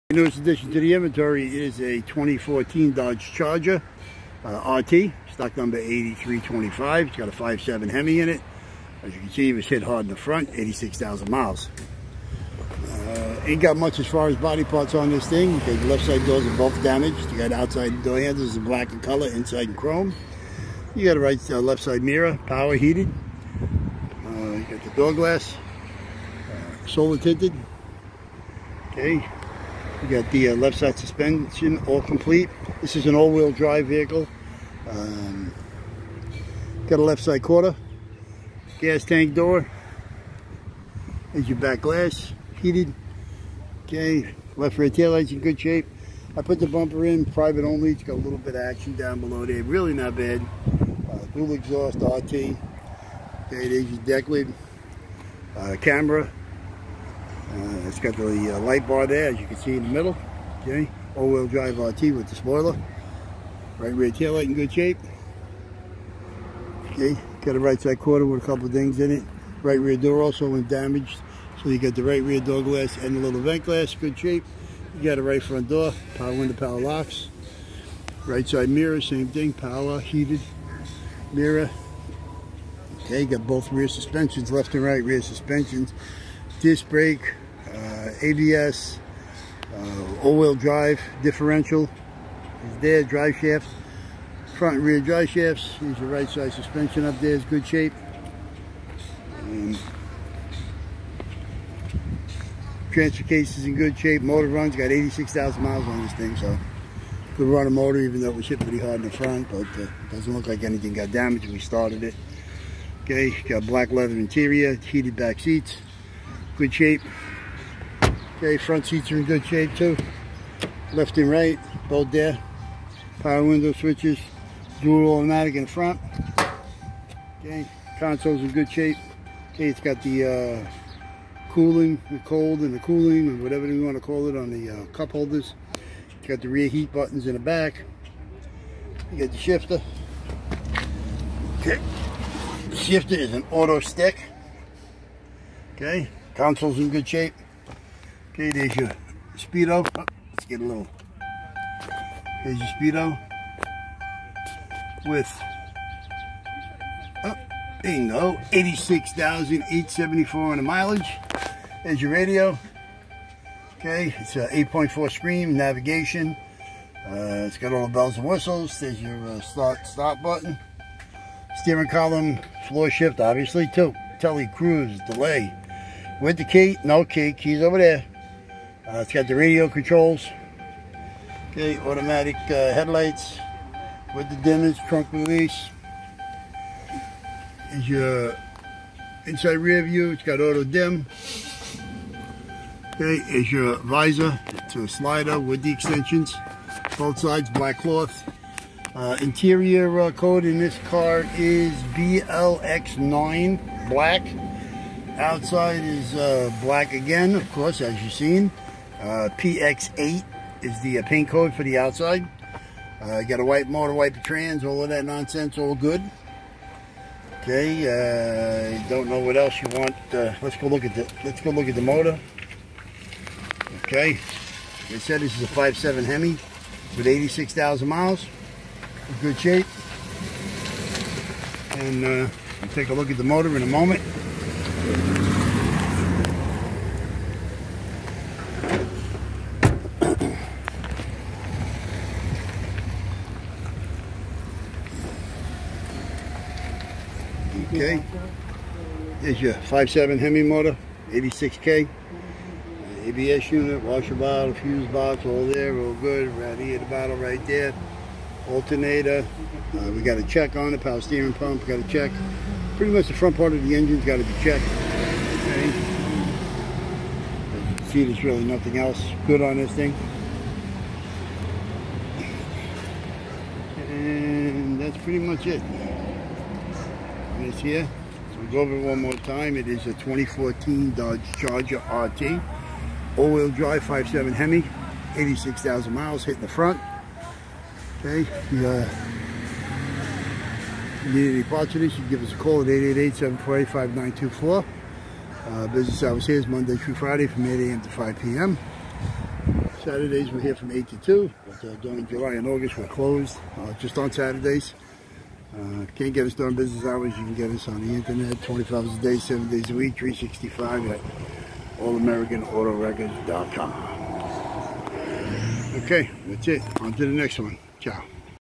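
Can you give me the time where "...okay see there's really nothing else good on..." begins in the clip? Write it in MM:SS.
04:25.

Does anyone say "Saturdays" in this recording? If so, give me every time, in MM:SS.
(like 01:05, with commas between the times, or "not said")
04:59, 05:04.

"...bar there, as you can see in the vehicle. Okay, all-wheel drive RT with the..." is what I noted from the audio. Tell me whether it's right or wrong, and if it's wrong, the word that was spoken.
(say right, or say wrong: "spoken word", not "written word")
wrong: "middle", not "vehicle".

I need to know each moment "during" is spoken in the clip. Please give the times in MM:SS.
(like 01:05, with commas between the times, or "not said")
05:01, 05:06.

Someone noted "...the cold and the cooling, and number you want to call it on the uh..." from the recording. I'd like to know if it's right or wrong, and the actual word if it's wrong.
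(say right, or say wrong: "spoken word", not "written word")
wrong: "whatever", not "number".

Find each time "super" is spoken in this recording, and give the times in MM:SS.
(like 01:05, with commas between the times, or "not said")
not said.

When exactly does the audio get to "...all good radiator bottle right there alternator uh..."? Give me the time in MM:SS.
04:15.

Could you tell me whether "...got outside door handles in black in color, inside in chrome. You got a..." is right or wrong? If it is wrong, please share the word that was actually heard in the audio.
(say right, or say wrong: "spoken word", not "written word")
right.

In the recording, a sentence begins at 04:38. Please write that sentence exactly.
So we'll go over it one more time.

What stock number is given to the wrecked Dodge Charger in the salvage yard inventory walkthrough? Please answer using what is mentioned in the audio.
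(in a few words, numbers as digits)
8325.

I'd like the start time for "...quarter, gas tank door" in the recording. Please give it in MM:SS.
00:37.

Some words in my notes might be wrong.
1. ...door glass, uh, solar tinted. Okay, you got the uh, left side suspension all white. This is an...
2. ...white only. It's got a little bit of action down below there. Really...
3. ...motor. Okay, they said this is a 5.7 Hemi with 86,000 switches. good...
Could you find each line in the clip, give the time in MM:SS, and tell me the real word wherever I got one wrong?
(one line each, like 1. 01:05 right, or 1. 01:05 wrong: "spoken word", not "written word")
1. 00:24 wrong: "complete", not "white"
2. 00:47 wrong: "private", not "white"
3. 03:41 wrong: "miles", not "switches".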